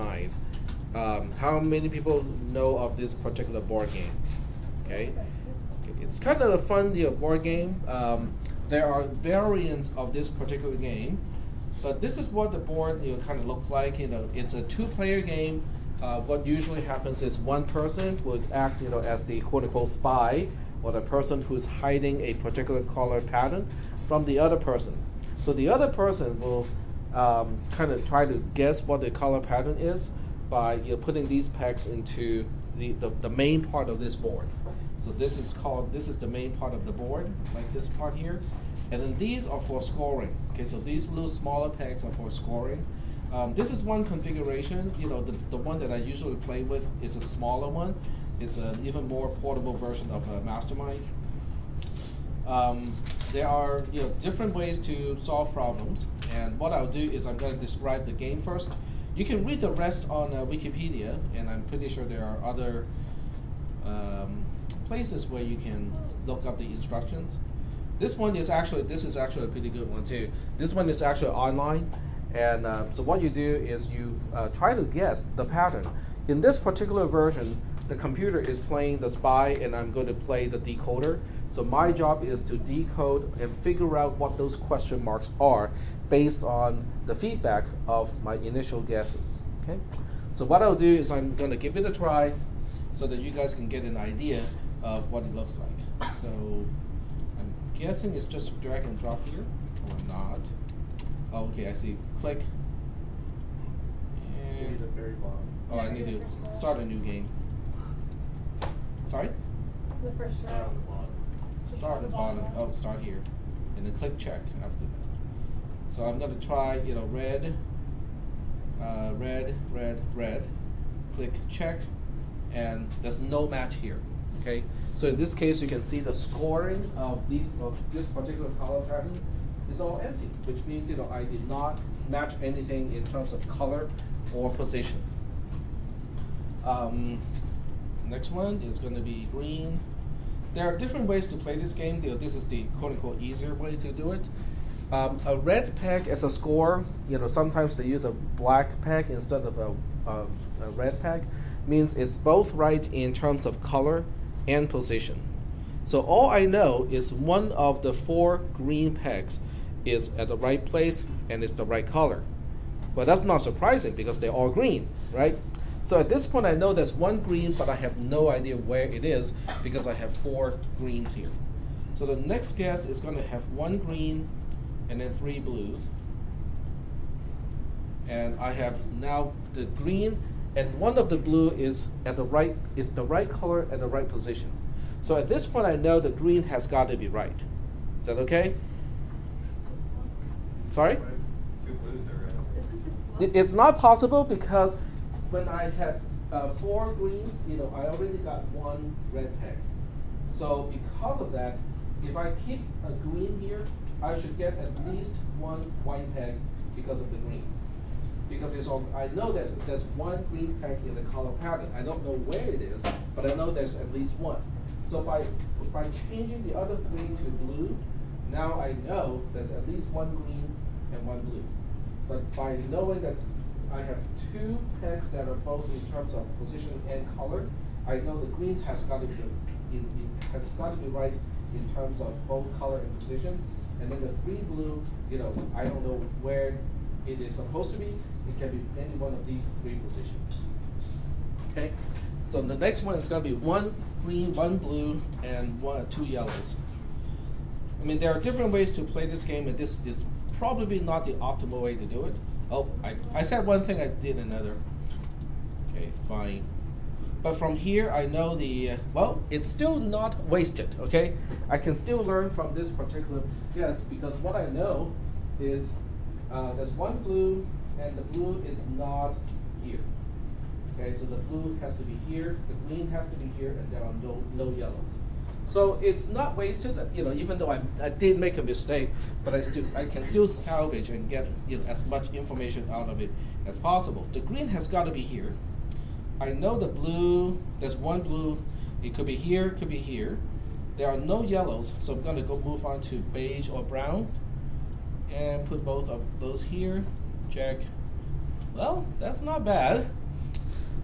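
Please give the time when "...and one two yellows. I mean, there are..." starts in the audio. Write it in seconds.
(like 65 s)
245 s.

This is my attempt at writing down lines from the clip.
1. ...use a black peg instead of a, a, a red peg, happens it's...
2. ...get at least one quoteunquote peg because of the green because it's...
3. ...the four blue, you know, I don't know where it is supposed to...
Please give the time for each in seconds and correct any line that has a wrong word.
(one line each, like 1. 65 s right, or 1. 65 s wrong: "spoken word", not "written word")
1. 147 s wrong: "means", not "happens"
2. 204 s wrong: "white", not "quoteunquote"
3. 233 s wrong: "three", not "four".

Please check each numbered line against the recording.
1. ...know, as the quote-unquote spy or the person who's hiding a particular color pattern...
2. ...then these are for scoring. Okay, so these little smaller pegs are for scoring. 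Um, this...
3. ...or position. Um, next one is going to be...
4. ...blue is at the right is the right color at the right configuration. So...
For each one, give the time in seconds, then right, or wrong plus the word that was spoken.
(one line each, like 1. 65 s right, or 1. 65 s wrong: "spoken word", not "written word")
1. 18 s right
2. 39 s right
3. 134 s right
4. 181 s wrong: "position", not "configuration".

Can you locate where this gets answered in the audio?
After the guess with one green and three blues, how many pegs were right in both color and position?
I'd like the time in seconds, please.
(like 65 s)
224 s.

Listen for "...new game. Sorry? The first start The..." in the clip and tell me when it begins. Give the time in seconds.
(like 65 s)
106 s.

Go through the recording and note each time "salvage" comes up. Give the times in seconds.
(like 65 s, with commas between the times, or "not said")
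280 s.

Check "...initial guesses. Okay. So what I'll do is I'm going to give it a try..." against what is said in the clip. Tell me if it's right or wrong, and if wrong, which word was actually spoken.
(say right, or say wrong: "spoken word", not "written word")
right.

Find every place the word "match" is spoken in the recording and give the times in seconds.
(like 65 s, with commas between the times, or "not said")
123 s, 132 s.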